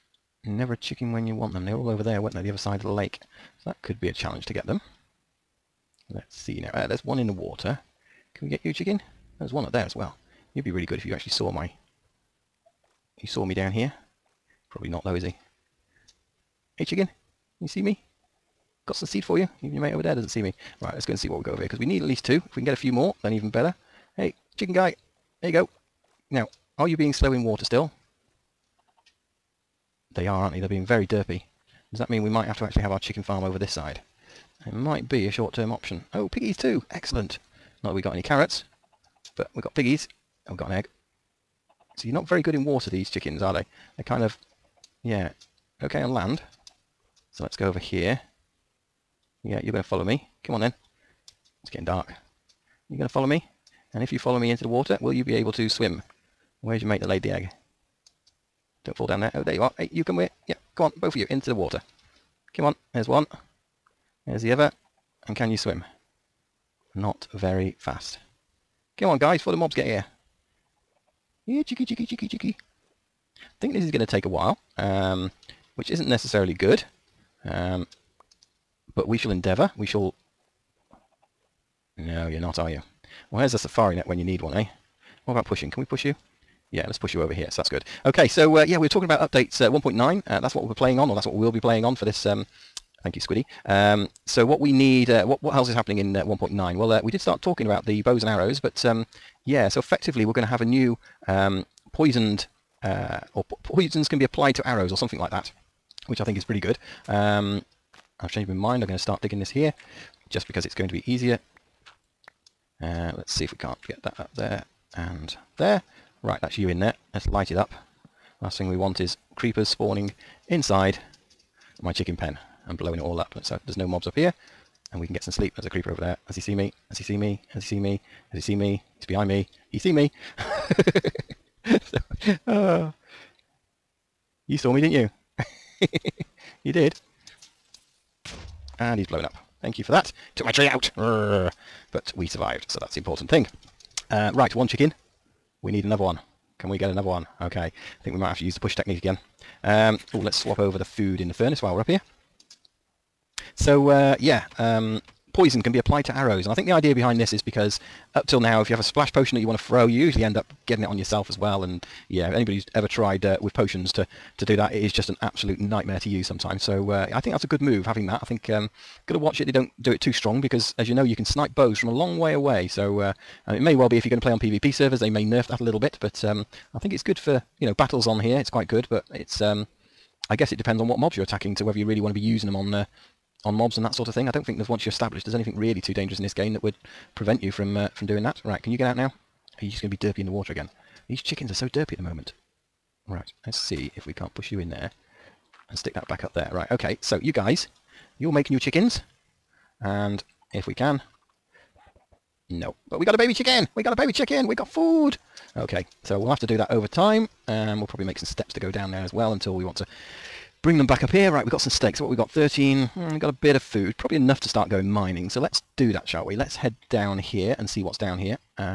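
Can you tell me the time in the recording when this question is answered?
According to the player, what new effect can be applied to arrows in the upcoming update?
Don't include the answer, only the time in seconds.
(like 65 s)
103 s.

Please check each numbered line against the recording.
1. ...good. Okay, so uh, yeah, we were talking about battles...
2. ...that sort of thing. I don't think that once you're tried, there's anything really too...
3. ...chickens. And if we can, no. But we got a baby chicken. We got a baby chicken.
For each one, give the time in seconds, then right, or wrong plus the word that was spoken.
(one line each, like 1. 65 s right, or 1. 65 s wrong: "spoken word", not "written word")
1. 87 s wrong: "updates", not "battles"
2. 183 s wrong: "established", not "tried"
3. 198 s right.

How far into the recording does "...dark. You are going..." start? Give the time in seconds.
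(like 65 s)
51 s.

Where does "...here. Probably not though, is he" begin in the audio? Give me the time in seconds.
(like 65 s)
13 s.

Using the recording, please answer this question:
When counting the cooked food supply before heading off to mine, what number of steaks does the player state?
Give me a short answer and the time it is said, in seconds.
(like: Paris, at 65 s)
13, at 212 s.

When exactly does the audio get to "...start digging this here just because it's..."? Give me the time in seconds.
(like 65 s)
109 s.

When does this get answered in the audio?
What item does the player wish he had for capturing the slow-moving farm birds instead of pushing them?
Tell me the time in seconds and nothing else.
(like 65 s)
83 s.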